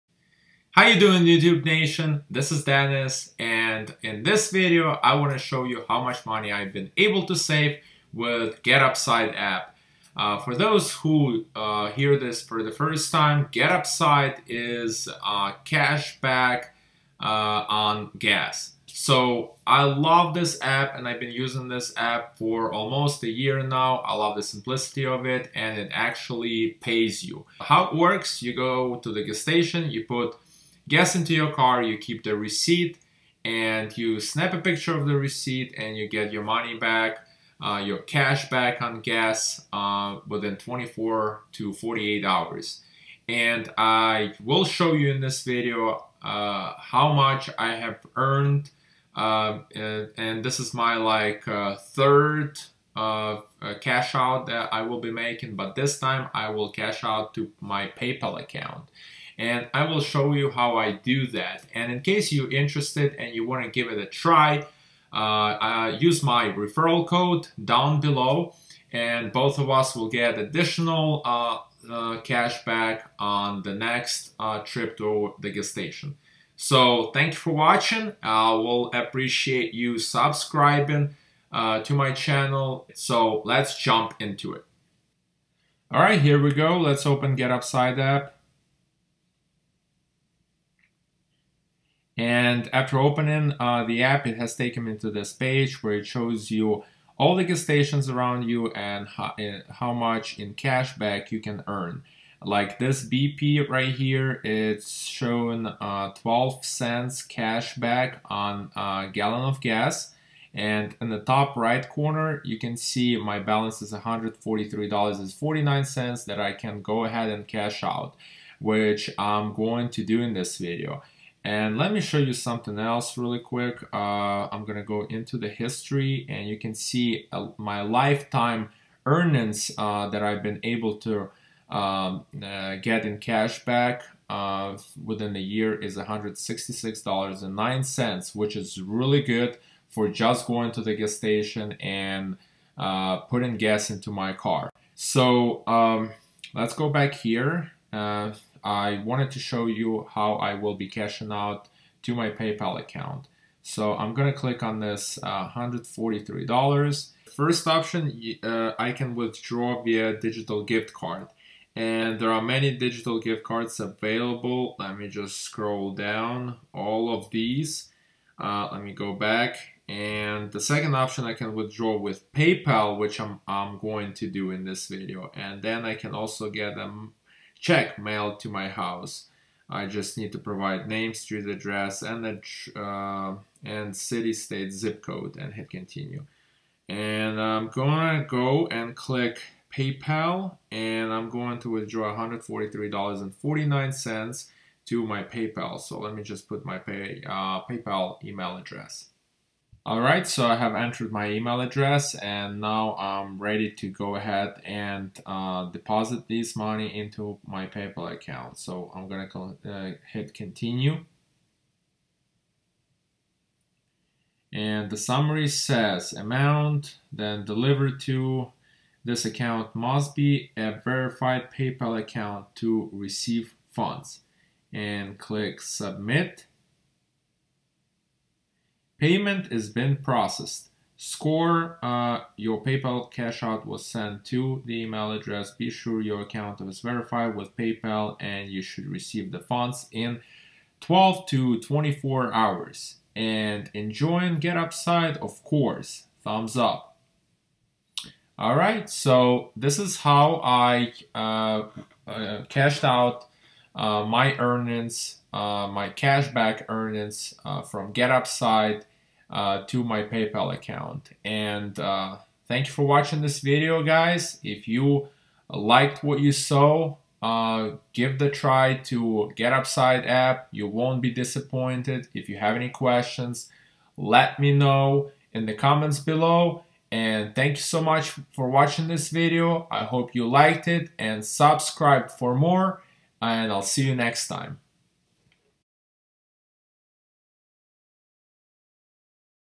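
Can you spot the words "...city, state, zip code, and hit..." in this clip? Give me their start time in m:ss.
3:03.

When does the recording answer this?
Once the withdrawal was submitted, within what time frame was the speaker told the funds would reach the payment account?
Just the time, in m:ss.
4:00.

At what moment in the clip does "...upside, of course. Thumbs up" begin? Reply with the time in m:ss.
4:04.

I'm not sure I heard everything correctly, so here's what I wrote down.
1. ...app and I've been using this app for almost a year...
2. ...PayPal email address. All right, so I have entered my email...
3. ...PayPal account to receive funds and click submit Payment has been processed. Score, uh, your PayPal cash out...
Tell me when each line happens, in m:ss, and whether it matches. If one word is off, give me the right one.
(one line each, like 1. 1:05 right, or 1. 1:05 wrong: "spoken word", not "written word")
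1. 0:20 right
2. 3:17 right
3. 3:41 right.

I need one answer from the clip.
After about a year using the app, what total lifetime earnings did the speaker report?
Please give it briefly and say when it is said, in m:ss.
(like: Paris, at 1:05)
$166.09, at 2:15.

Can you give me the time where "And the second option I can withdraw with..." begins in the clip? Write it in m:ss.
2:49.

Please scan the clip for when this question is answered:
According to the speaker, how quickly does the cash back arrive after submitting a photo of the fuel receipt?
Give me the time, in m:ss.
0:40.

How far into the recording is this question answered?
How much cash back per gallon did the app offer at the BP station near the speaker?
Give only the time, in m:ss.
1:46.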